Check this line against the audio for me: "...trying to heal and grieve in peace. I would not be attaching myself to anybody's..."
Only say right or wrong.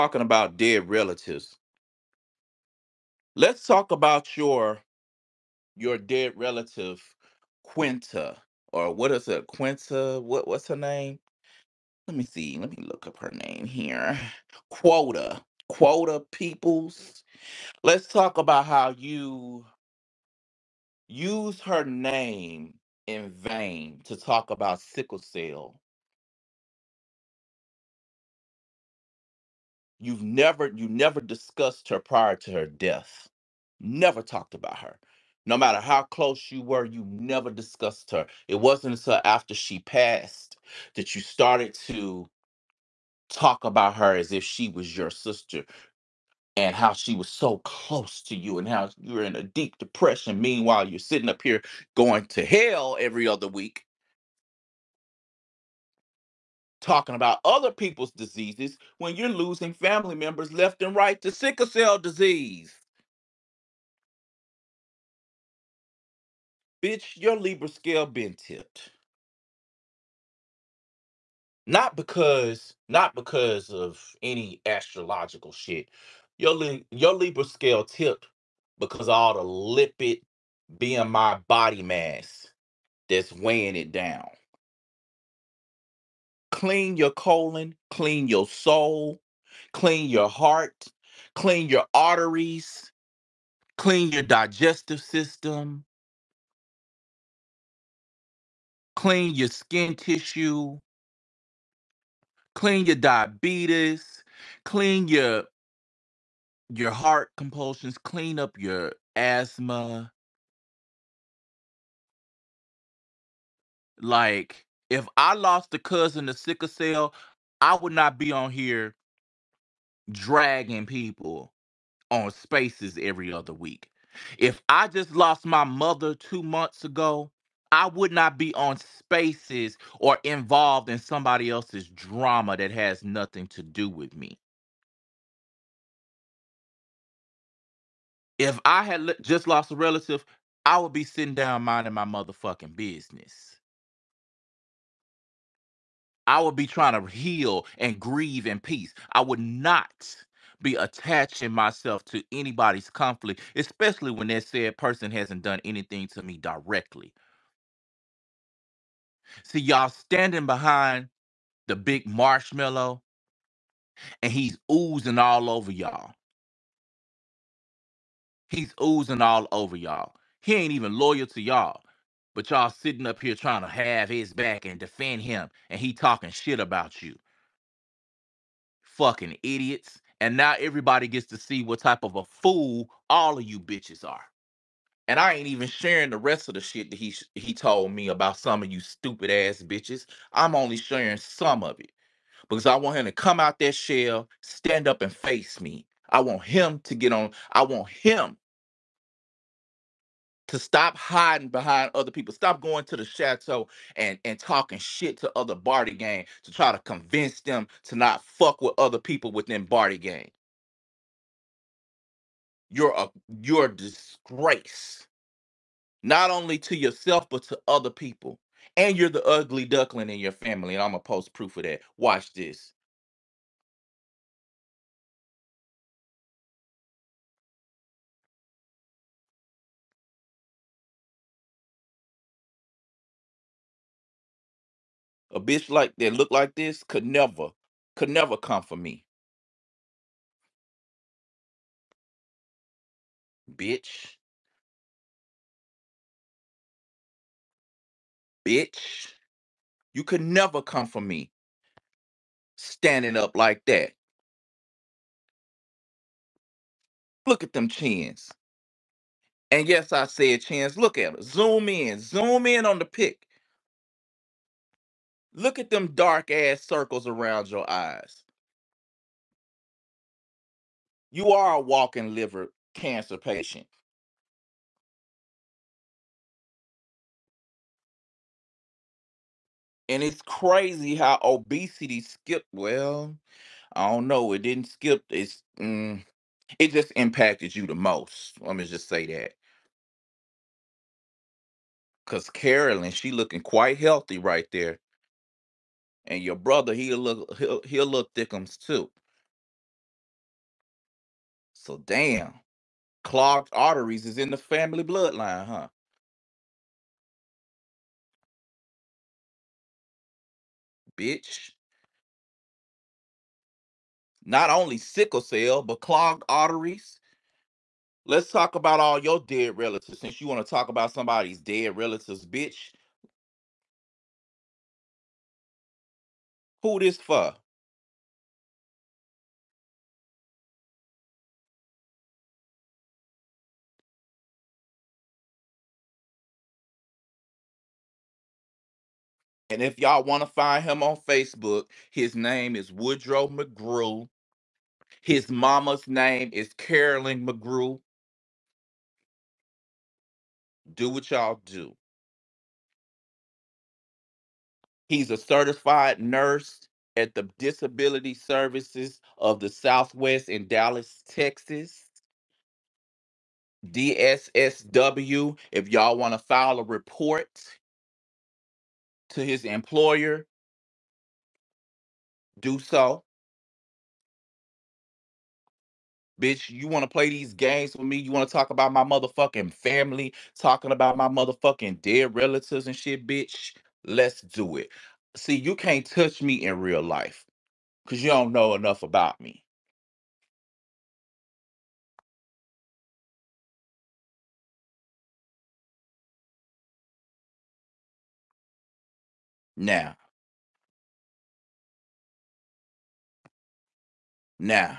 right.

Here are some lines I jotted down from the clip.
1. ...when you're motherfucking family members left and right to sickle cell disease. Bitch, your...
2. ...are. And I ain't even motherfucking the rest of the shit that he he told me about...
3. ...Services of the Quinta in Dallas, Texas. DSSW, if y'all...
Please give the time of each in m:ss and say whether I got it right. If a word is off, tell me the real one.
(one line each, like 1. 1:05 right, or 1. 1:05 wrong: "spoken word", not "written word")
1. 0:58 wrong: "losing", not "motherfucking"
2. 3:04 wrong: "sharing", not "motherfucking"
3. 5:58 wrong: "Southwest", not "Quinta".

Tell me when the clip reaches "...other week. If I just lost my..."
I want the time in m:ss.
2:03.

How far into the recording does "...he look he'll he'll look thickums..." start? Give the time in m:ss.
4:56.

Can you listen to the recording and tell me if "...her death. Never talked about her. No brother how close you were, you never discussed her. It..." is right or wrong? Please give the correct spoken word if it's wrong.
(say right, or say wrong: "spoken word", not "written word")
wrong: "matter", not "brother".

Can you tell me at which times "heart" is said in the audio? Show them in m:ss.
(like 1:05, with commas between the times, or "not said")
1:30, 1:46.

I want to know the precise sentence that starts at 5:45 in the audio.
His mama's name is Carolyn McGrew.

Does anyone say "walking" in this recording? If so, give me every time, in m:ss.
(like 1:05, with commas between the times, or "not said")
4:31.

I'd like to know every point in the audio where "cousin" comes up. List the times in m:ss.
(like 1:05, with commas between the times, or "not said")
1:55.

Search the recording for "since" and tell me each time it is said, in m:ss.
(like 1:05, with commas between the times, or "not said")
5:20.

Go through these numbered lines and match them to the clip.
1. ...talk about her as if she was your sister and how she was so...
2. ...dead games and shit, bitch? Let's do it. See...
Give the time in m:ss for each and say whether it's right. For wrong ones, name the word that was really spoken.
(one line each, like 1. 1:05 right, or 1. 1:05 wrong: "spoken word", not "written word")
1. 0:43 right
2. 6:21 wrong: "relatives", not "games".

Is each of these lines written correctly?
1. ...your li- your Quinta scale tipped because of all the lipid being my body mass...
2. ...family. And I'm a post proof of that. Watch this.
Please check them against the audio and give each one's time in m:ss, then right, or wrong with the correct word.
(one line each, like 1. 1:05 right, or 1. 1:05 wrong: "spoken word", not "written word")
1. 1:16 wrong: "Libra", not "Quinta"
2. 3:40 right.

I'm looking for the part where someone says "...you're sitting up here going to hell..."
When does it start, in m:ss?
0:50.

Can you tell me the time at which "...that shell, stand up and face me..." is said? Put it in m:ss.
3:13.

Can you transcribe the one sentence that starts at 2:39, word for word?
See, y'all standing behind the big marshmallow and he's oozing all over y'all.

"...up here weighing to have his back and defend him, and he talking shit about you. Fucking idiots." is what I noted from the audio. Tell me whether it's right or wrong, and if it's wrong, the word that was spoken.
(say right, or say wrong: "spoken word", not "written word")
wrong: "trying", not "weighing".